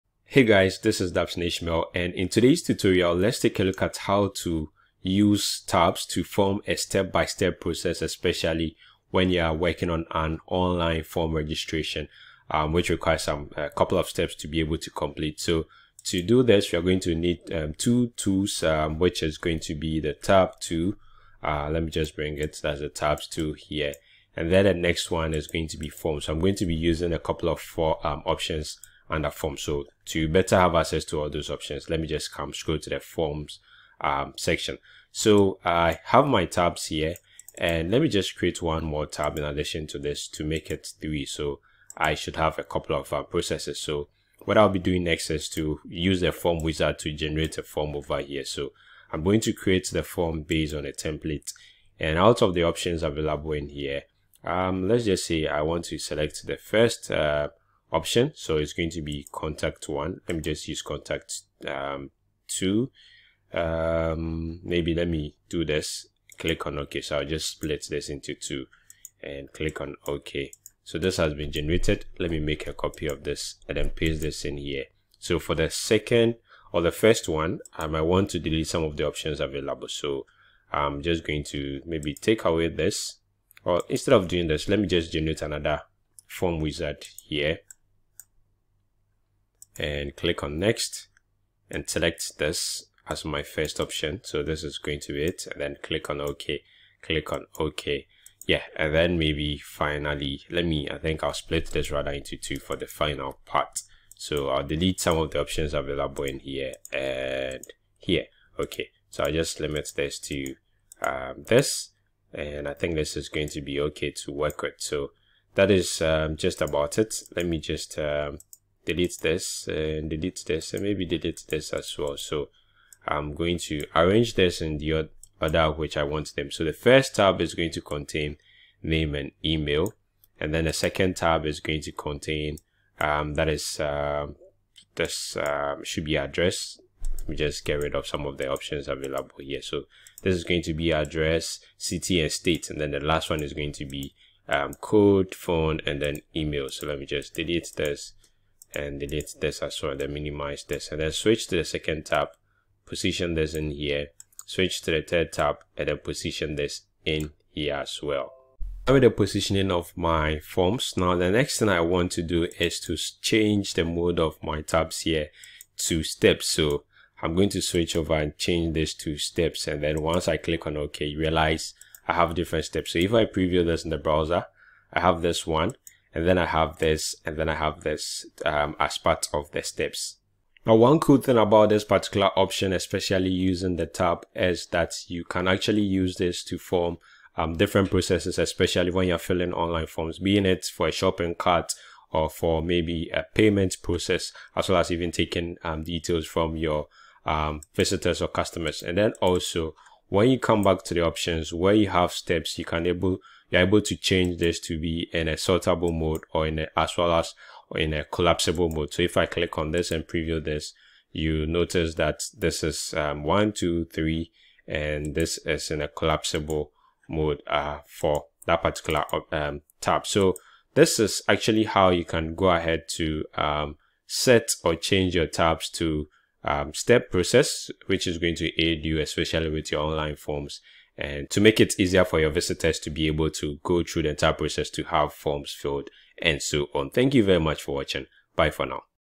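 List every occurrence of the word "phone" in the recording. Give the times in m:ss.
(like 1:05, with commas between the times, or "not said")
2:25.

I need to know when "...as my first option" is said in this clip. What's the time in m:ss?
1:33.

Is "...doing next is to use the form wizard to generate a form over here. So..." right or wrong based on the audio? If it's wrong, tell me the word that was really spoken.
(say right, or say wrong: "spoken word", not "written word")
right.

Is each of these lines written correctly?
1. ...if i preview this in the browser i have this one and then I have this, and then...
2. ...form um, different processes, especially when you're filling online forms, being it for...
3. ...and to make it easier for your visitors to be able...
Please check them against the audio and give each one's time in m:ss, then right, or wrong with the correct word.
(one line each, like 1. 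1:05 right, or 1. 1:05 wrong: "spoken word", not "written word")
1. 2:52 right
2. 3:06 right
3. 3:50 right.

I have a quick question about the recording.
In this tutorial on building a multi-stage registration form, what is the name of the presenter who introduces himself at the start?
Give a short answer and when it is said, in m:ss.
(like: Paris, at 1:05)
Dapson Ishmeal, at 0:01.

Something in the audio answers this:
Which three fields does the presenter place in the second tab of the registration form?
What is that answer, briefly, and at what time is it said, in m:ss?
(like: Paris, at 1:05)
address, city and state, at 2:20.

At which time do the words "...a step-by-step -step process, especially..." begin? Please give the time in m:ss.
0:06.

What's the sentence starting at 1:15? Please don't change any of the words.
So for the second or the first one, I might want to delete some of the options available.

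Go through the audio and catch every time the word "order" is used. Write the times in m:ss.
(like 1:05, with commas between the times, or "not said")
2:05.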